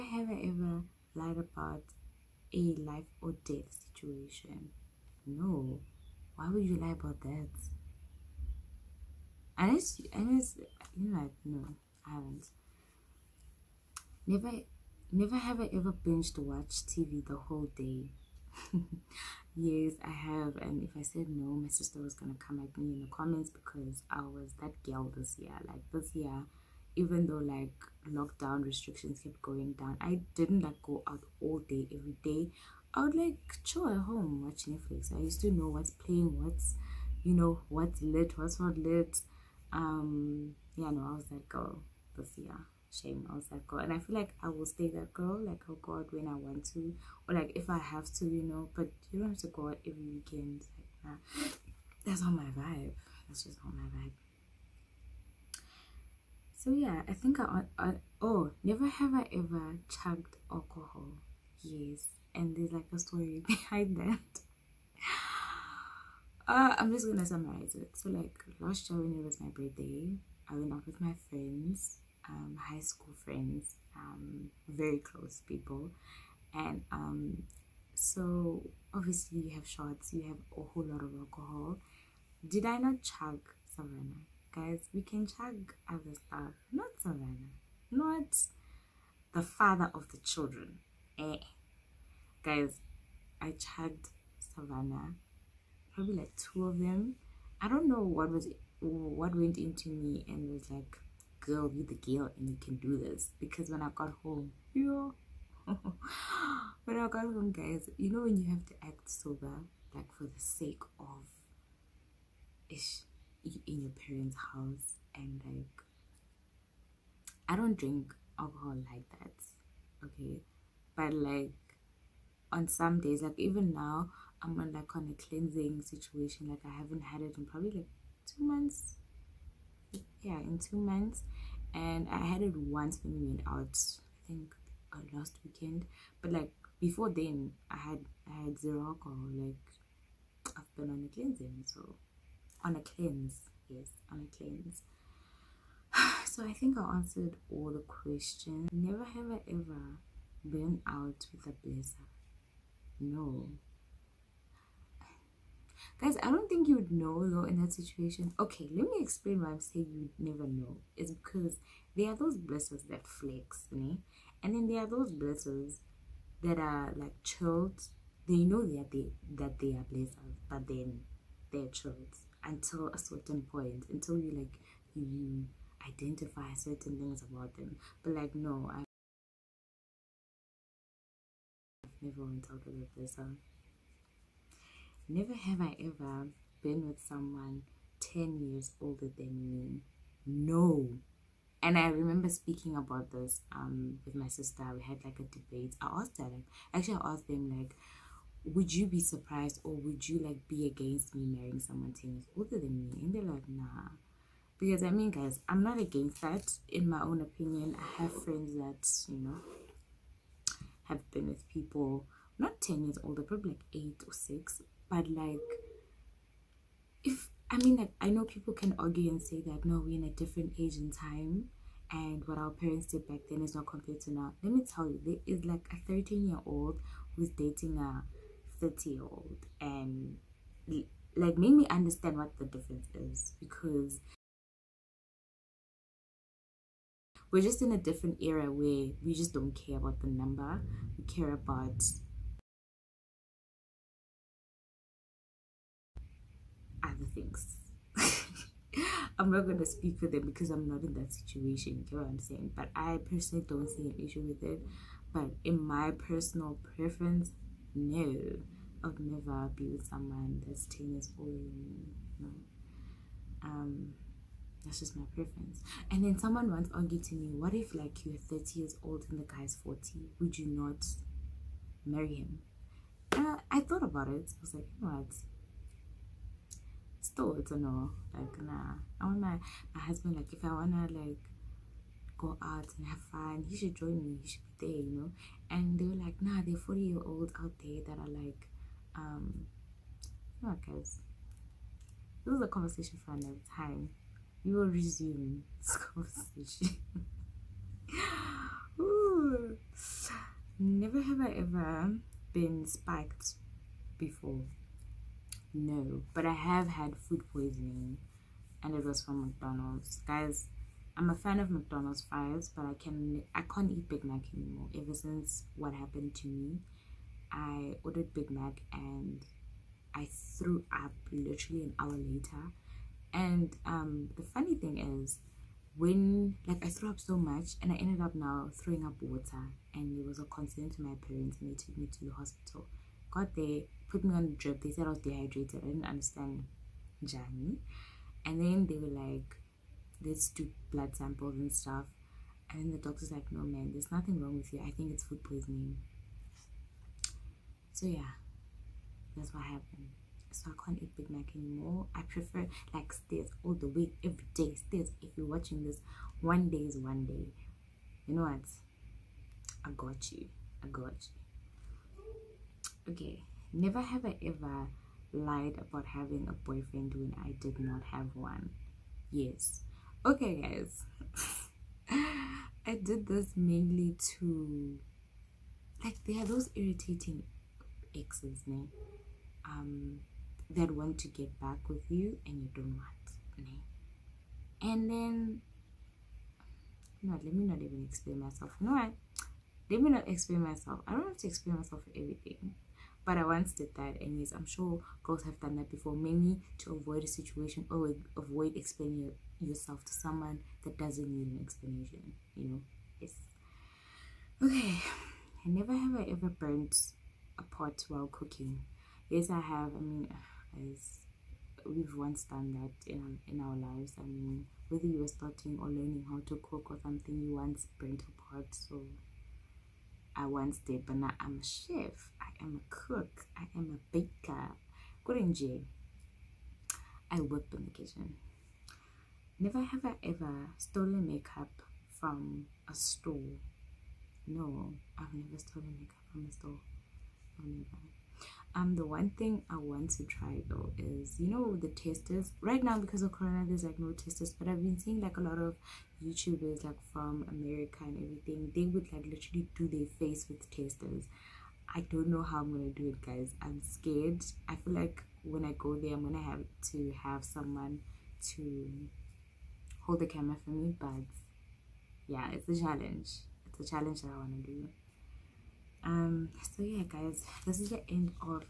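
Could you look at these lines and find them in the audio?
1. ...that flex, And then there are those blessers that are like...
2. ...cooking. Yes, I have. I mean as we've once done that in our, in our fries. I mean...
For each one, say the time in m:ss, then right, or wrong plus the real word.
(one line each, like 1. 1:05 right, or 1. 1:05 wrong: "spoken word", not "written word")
1. 2:42 right
2. 6:48 wrong: "lives", not "fries".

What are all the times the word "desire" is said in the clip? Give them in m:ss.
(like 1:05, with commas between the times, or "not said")
not said.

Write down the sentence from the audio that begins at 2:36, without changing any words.
Guys, I don't think you'd know though in that situation.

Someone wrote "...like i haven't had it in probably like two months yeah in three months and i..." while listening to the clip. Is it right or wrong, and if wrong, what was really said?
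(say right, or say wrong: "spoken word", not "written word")
wrong: "two", not "three".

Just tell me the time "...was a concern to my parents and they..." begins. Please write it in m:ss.
5:30.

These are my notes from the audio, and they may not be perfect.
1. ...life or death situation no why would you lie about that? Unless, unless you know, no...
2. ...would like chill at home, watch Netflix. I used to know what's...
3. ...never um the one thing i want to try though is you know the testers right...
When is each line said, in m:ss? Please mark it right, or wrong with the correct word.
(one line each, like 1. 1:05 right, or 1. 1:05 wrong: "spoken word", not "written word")
1. 0:02 right
2. 0:33 right
3. 7:17 right.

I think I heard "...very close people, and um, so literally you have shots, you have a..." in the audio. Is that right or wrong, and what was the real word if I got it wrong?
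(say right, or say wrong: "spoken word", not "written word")
wrong: "obviously", not "literally".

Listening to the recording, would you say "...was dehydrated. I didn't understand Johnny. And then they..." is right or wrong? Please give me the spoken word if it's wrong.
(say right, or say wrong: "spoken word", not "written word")
right.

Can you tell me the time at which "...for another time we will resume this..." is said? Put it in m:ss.
4:53.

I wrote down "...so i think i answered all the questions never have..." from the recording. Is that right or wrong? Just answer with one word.
right.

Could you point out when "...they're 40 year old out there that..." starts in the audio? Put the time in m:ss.
4:46.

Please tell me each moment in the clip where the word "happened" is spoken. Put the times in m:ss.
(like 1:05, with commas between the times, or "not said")
5:15, 5:49.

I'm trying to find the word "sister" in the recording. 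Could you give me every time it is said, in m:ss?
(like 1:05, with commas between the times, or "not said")
0:21, 3:14.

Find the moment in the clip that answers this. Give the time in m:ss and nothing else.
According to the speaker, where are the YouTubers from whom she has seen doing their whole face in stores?
7:27.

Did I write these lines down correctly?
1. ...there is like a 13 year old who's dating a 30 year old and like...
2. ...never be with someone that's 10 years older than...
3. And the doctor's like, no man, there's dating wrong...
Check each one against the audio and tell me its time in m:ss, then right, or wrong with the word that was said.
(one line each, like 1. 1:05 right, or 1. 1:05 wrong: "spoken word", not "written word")
1. 3:45 right
2. 4:19 right
3. 5:42 wrong: "nothing", not "dating".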